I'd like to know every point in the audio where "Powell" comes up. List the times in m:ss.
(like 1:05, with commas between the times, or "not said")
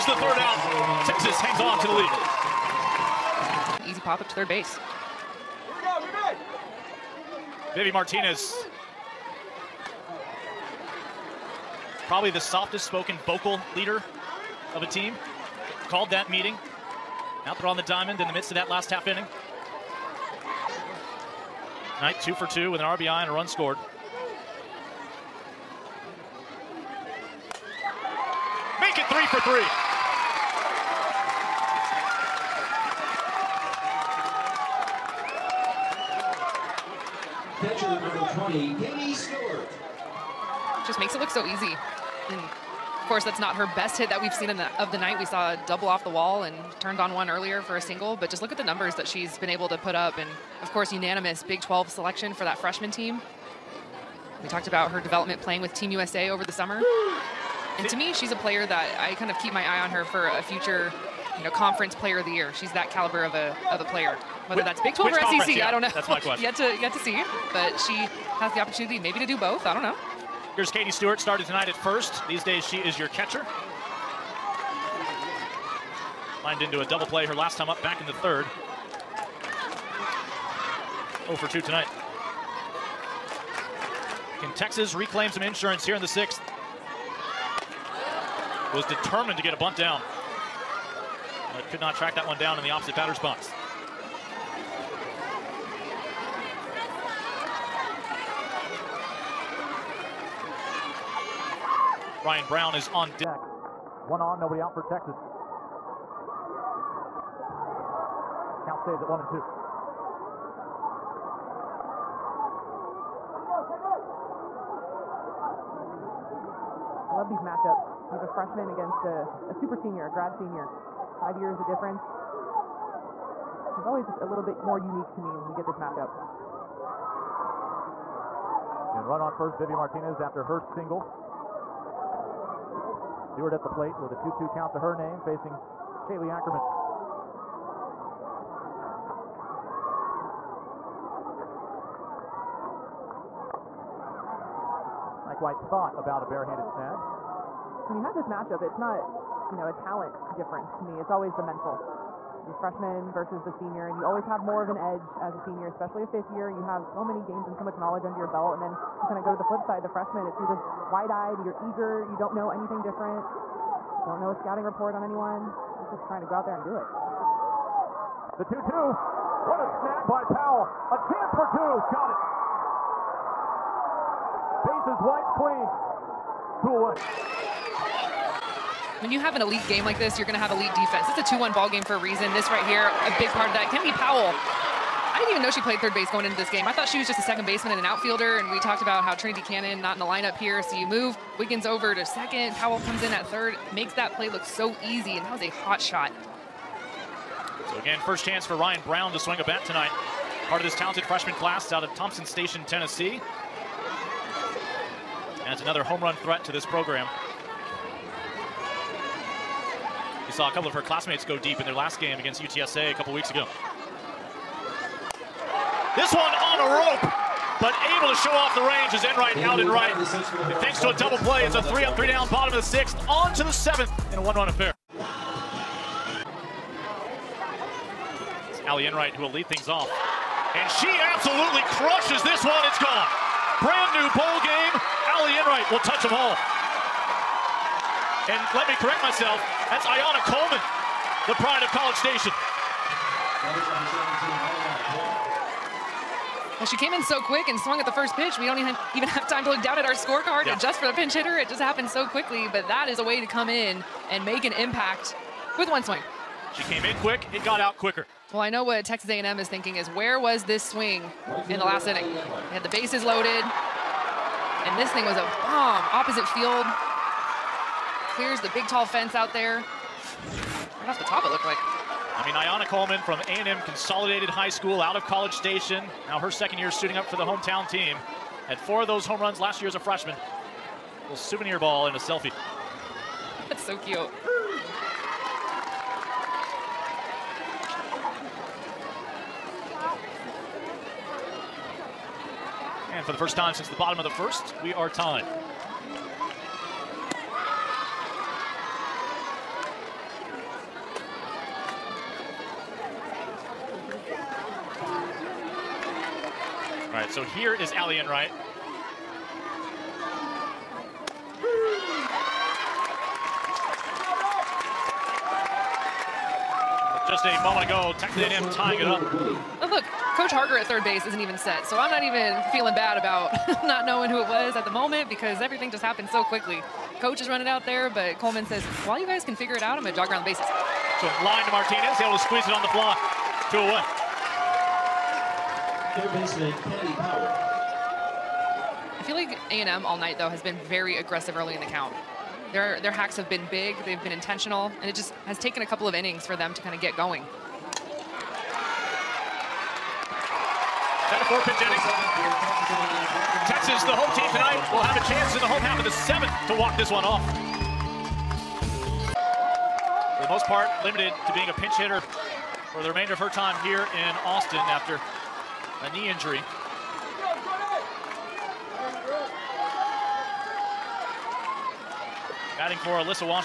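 2:50, 3:03, 3:12, 5:36.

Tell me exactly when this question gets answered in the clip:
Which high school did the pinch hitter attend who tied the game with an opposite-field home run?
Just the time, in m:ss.
4:33.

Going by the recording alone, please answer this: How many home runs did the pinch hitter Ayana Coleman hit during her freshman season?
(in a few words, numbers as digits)
4.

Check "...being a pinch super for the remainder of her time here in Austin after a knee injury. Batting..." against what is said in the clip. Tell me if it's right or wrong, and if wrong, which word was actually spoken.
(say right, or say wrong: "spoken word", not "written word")
wrong: "hitter", not "super".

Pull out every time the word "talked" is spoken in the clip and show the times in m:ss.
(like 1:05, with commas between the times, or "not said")
0:54, 3:08.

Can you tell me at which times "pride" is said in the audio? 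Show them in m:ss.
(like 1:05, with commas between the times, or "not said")
4:01.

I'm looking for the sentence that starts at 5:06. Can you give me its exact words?
All right, so here is Allie Enright.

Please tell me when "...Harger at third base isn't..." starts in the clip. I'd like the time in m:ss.
5:20.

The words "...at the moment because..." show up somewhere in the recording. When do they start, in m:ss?
5:24.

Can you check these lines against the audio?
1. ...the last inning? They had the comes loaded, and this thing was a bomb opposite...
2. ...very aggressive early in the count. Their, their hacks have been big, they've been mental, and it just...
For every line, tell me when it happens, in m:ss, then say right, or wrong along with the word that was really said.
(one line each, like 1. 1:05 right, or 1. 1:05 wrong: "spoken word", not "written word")
1. 4:21 wrong: "bases", not "comes"
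2. 5:40 wrong: "intentional", not "mental".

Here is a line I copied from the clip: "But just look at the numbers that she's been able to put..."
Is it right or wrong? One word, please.
right.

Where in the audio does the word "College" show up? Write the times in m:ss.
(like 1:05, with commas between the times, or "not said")
4:01, 4:35.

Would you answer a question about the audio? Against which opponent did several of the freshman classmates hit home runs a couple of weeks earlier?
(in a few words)
UTSA.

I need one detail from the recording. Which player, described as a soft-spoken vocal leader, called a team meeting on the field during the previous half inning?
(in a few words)
Vivi Martinez.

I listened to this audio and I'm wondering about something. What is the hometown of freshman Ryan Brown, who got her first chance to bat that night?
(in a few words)
Thompson Station, Tennessee.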